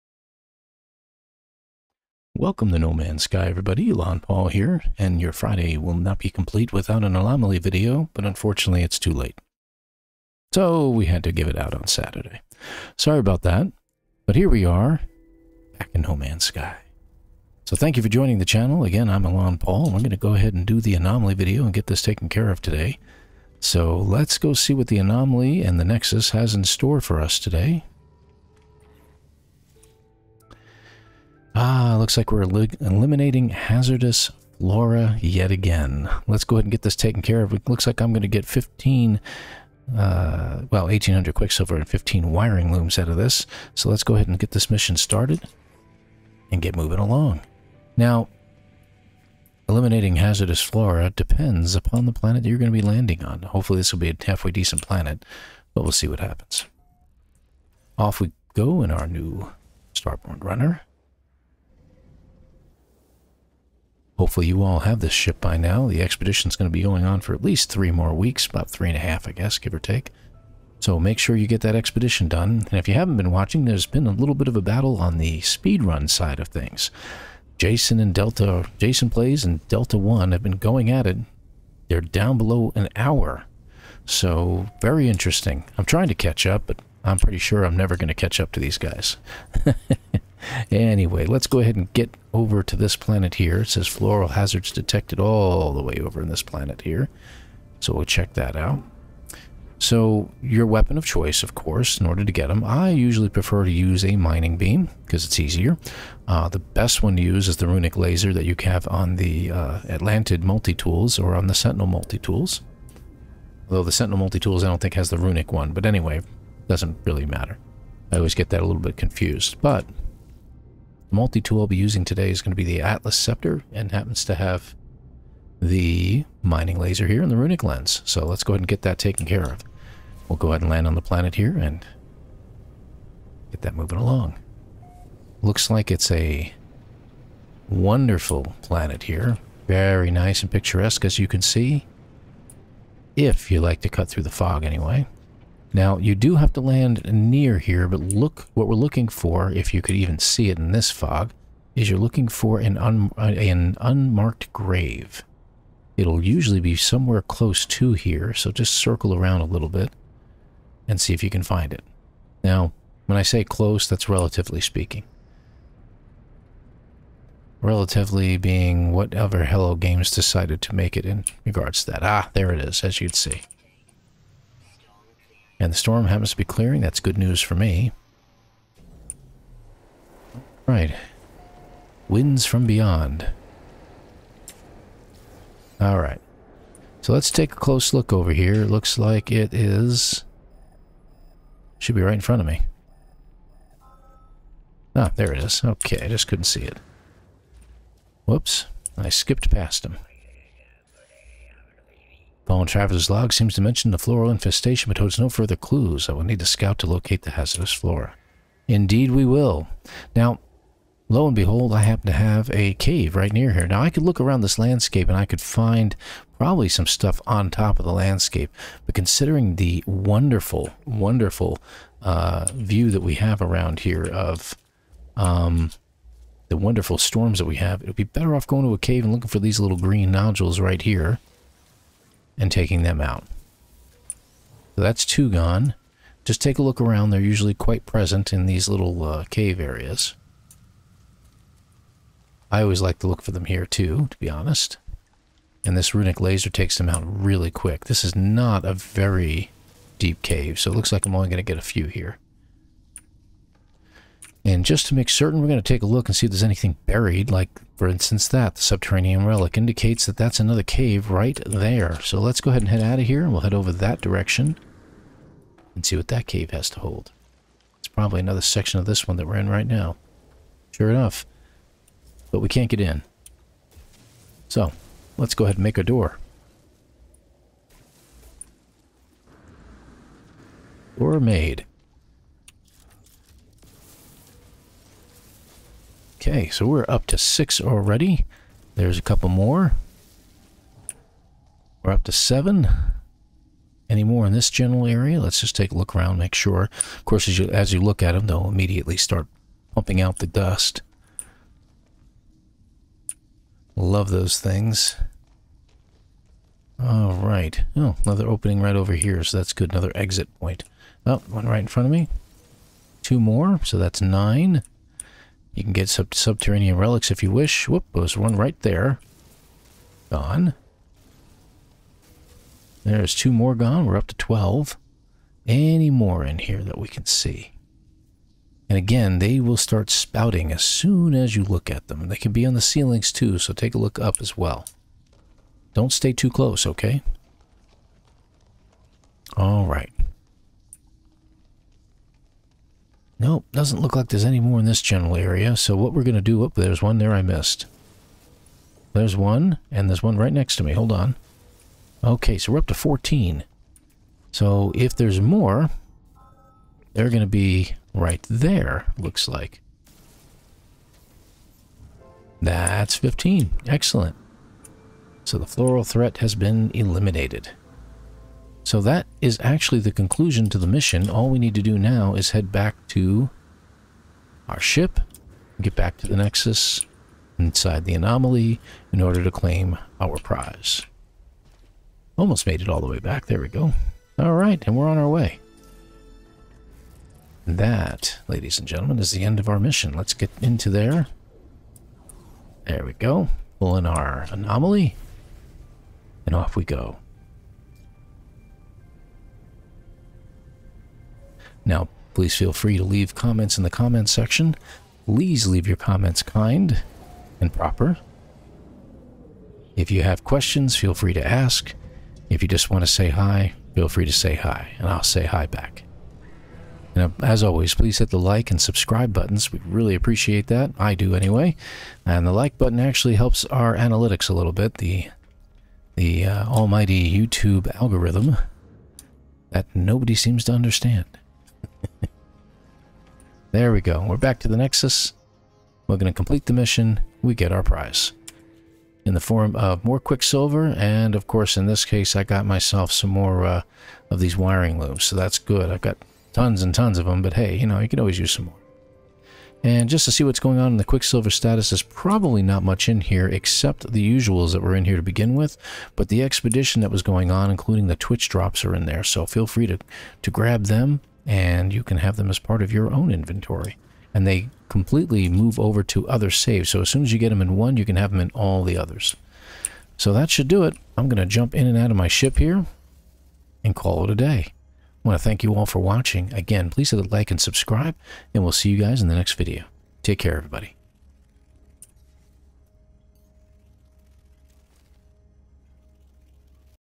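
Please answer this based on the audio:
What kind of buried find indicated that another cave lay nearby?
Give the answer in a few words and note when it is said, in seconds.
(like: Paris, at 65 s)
subterranean relic, at 258 s.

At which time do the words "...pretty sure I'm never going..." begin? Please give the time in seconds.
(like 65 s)
87 s.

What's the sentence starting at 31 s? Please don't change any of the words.
Ah, looks like we're eliminating hazardous flora yet again.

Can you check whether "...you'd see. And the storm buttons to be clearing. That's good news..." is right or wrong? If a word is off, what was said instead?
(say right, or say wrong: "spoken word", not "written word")
wrong: "happens", not "buttons".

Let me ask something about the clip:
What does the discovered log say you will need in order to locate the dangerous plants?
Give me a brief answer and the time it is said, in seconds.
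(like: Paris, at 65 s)
a scout, at 206 s.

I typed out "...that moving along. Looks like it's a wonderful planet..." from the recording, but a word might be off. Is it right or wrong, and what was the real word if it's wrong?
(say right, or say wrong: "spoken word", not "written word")
right.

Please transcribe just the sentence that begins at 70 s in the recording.
So make sure you get that expedition done.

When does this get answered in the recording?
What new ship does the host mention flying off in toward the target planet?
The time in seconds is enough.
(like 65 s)
59 s.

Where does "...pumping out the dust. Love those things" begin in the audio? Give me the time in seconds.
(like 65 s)
299 s.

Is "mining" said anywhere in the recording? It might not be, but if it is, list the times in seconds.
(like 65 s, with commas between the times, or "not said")
104 s, 126 s.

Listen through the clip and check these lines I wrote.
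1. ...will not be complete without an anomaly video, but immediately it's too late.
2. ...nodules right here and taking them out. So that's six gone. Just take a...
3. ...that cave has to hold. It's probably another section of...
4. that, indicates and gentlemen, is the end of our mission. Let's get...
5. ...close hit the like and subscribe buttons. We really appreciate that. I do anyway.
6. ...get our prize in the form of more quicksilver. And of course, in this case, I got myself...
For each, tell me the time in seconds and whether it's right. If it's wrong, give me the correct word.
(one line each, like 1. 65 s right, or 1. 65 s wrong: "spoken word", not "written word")
1. 5 s wrong: "unfortunately", not "immediately"
2. 230 s wrong: "two", not "six"
3. 266 s right
4. 387 s wrong: "ladies", not "indicates"
5. 417 s wrong: "please", not "close"
6. 437 s right.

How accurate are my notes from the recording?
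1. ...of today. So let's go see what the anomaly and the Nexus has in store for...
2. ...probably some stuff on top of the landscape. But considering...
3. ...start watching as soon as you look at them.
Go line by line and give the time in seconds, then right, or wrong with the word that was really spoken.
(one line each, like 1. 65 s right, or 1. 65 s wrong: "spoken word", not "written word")
1. 22 s right
2. 216 s right
3. 329 s wrong: "spouting", not "watching".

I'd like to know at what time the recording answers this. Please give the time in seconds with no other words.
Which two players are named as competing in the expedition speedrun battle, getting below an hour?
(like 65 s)
78 s.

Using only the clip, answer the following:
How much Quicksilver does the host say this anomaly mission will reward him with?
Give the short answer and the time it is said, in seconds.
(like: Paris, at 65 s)
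1800, at 40 s.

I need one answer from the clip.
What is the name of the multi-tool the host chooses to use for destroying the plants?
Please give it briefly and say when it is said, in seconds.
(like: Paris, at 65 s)
Atlas Scepter, at 122 s.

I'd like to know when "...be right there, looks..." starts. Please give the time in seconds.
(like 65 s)
357 s.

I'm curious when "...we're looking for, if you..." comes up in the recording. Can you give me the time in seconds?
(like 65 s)
148 s.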